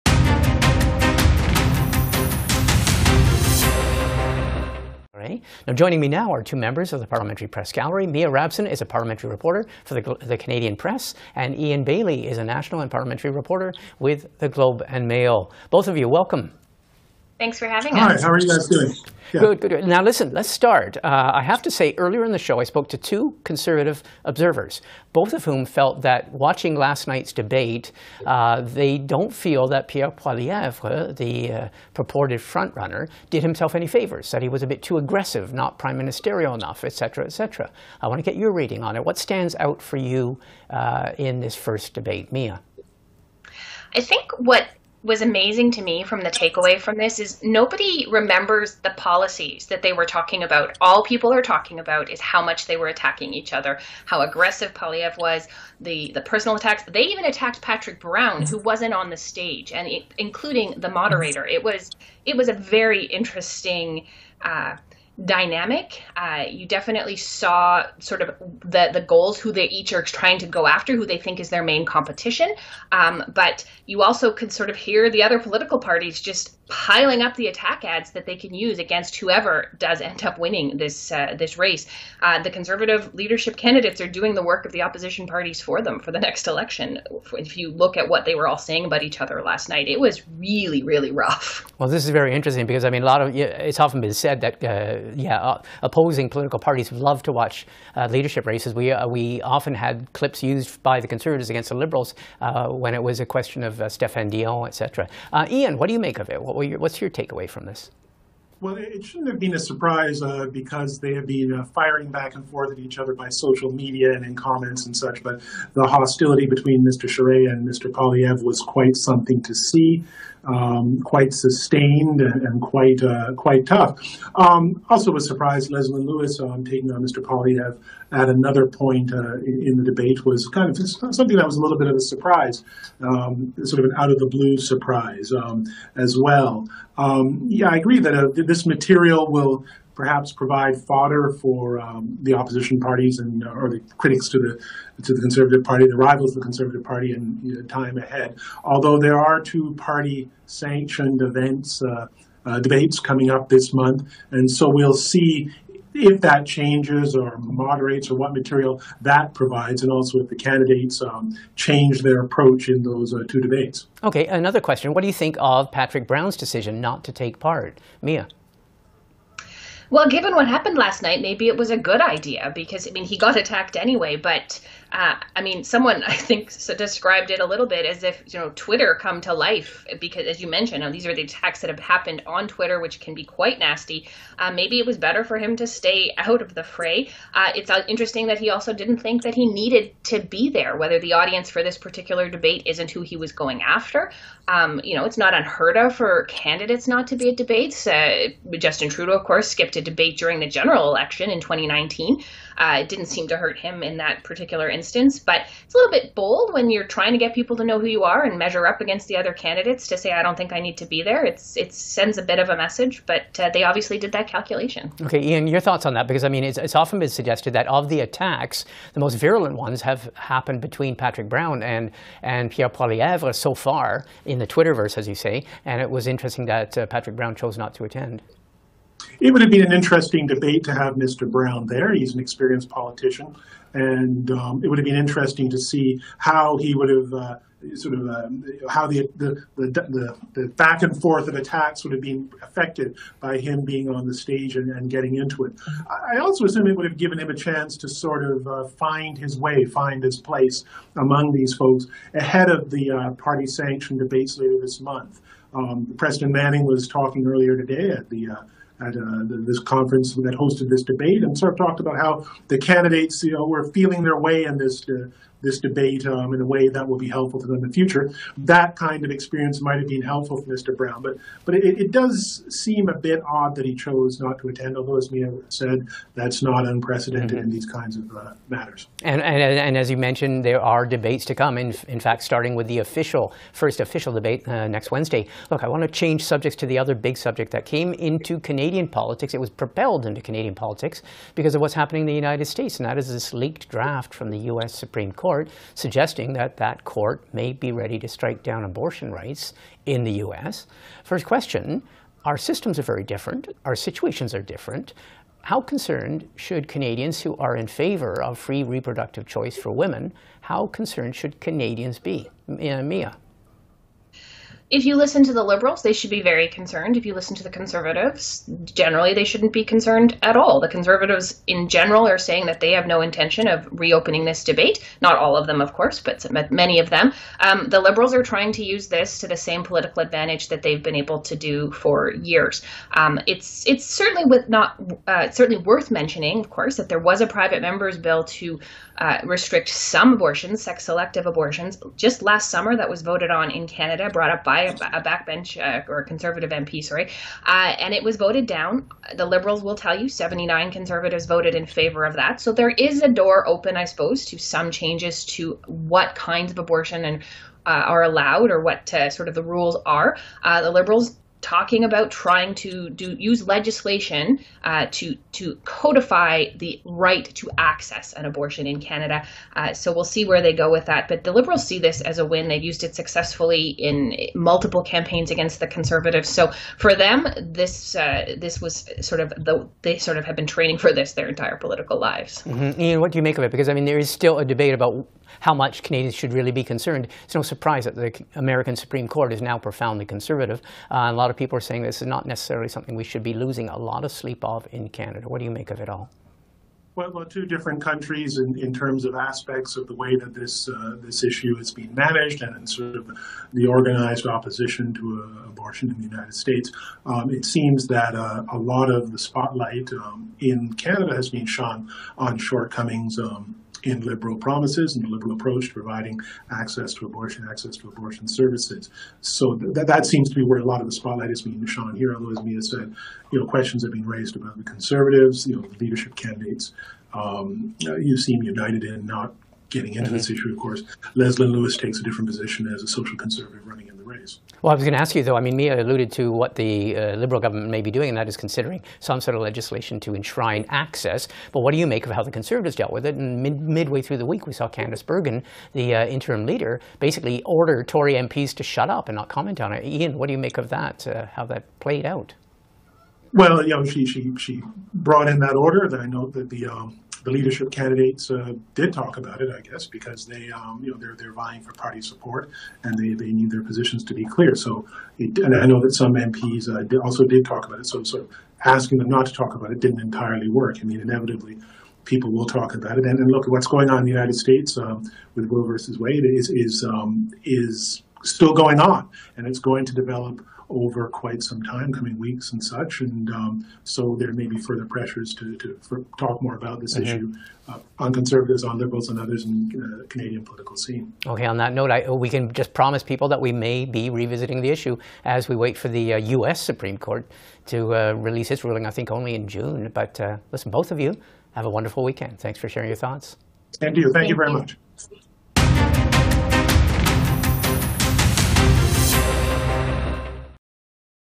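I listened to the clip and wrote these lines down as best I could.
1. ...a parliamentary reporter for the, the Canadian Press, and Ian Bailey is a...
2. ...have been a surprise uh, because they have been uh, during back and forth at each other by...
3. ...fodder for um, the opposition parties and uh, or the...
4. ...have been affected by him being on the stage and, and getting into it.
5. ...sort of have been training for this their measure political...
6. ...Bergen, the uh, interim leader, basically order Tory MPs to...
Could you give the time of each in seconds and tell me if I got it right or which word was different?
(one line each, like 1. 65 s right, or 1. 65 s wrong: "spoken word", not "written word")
1. 8 s right
2. 109 s wrong: "firing", not "during"
3. 140 s right
4. 241 s right
5. 379 s wrong: "entire", not "measure"
6. 445 s right.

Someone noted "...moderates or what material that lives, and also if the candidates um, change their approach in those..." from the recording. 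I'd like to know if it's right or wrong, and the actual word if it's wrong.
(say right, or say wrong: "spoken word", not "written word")
wrong: "provides", not "lives".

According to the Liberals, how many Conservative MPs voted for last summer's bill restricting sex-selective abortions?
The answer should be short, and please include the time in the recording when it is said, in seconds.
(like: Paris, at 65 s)
79, at 350 s.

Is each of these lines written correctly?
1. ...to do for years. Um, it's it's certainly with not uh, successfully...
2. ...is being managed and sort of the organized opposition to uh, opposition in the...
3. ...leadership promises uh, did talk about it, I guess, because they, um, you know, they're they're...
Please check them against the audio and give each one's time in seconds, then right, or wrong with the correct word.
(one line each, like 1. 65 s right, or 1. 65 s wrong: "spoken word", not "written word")
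1. 331 s wrong: "certainly", not "successfully"
2. 401 s wrong: "abortion", not "opposition"
3. 457 s wrong: "candidates", not "promises".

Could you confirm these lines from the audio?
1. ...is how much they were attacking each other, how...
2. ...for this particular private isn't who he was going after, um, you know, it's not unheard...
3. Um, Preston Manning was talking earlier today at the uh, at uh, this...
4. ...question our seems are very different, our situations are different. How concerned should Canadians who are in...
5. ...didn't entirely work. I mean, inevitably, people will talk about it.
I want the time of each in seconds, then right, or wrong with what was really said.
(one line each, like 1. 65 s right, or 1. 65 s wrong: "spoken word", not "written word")
1. 52 s right
2. 191 s wrong: "debate", not "private"
3. 255 s right
4. 301 s wrong: "systems", not "seems"
5. 469 s right.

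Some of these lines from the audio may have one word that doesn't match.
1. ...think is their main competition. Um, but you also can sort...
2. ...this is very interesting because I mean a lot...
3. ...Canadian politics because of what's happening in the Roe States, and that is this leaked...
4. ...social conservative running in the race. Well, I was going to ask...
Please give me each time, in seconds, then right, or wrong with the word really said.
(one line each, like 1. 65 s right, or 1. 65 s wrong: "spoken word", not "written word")
1. 71 s right
2. 91 s right
3. 290 s wrong: "United", not "Roe"
4. 432 s right.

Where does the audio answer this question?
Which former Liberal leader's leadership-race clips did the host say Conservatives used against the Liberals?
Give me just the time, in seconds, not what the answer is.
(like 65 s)
103 s.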